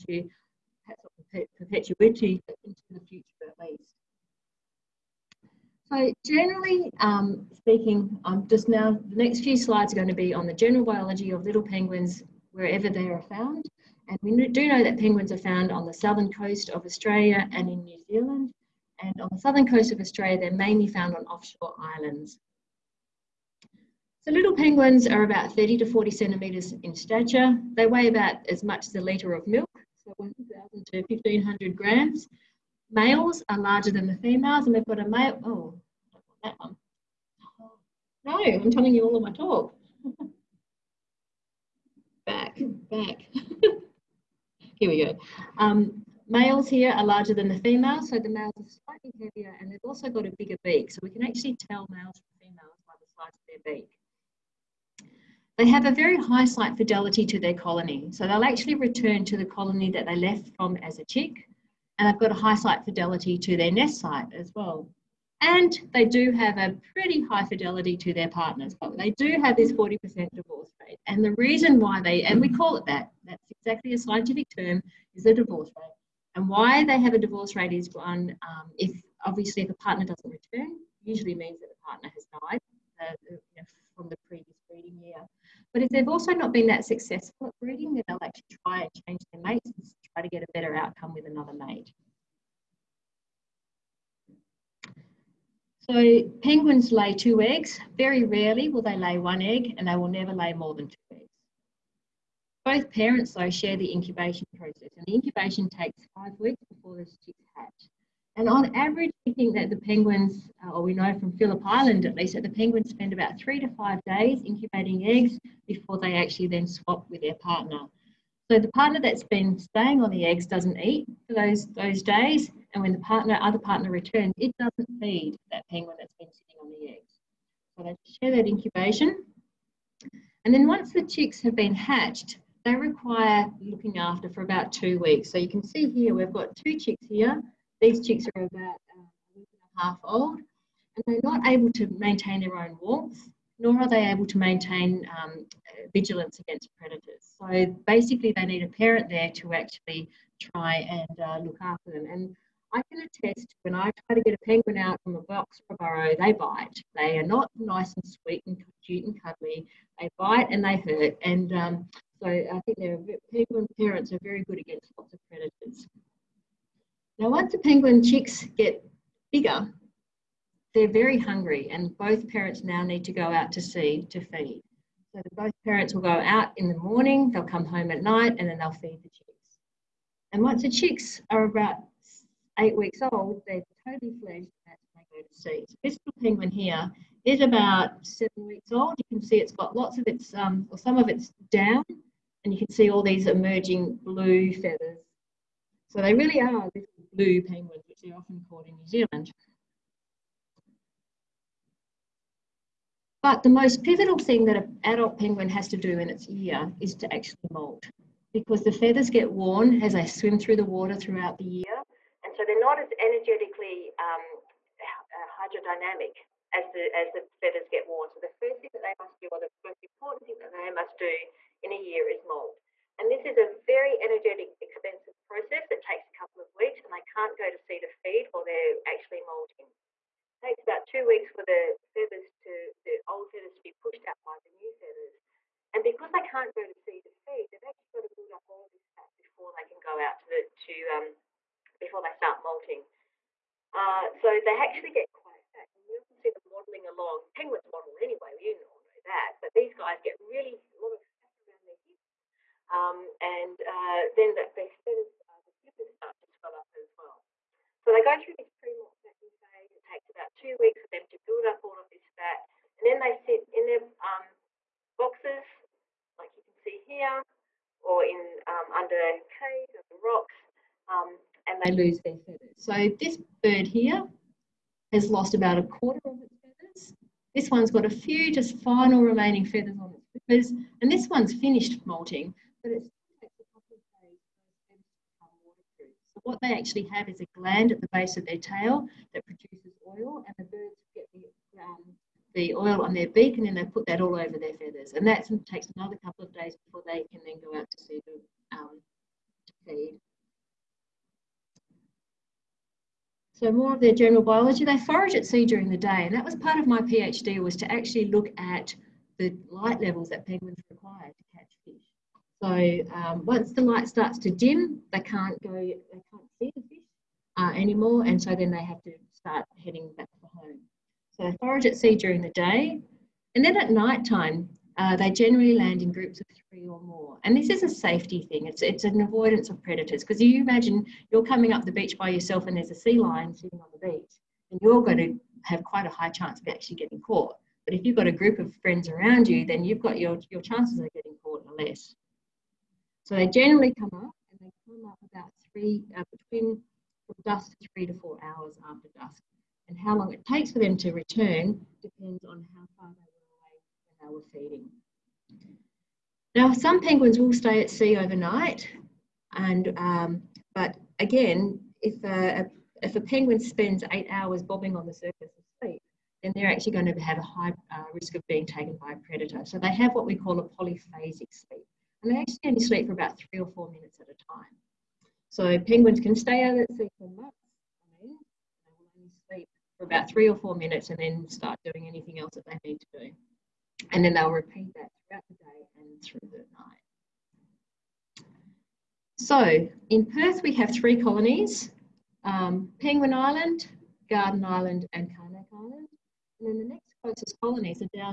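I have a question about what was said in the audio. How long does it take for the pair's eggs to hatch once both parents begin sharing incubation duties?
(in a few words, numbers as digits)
Five weeks.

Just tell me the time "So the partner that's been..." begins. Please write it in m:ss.
1:58.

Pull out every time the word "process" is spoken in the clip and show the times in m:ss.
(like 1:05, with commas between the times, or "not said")
1:44, 3:45.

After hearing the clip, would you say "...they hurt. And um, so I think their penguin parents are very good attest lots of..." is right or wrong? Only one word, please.
wrong.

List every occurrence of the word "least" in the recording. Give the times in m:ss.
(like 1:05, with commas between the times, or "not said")
0:03, 1:52.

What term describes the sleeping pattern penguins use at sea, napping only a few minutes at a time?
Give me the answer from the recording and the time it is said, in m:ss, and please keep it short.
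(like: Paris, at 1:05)
Polyphasic sleep, at 6:10.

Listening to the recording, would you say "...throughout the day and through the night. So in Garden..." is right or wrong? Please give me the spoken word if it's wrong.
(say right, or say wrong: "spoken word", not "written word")
wrong: "Perth", not "Garden".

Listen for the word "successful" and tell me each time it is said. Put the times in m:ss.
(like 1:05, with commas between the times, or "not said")
1:26.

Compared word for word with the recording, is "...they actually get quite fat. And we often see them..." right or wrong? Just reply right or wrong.
right.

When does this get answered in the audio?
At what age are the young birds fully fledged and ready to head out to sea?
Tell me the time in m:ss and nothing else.
3:02.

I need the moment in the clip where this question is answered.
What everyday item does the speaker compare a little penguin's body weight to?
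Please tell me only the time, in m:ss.
0:28.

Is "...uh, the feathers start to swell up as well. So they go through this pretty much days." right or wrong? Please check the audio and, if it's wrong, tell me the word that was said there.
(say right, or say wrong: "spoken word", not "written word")
right.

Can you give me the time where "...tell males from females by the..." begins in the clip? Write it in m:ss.
0:51.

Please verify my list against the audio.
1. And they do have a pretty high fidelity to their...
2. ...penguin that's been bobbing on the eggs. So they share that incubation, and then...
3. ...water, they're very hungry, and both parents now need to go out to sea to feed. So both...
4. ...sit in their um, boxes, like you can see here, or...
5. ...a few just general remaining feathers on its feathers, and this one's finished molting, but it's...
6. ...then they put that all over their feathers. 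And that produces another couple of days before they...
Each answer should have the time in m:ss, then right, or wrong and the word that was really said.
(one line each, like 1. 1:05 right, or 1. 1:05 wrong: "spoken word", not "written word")
1. 1:05 right
2. 2:05 wrong: "sitting", not "bobbing"
3. 2:49 wrong: "bigger", not "water"
4. 4:23 right
5. 4:37 wrong: "final", not "general"
6. 4:53 wrong: "takes", not "produces".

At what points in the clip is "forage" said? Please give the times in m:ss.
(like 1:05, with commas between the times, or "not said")
5:04, 5:21.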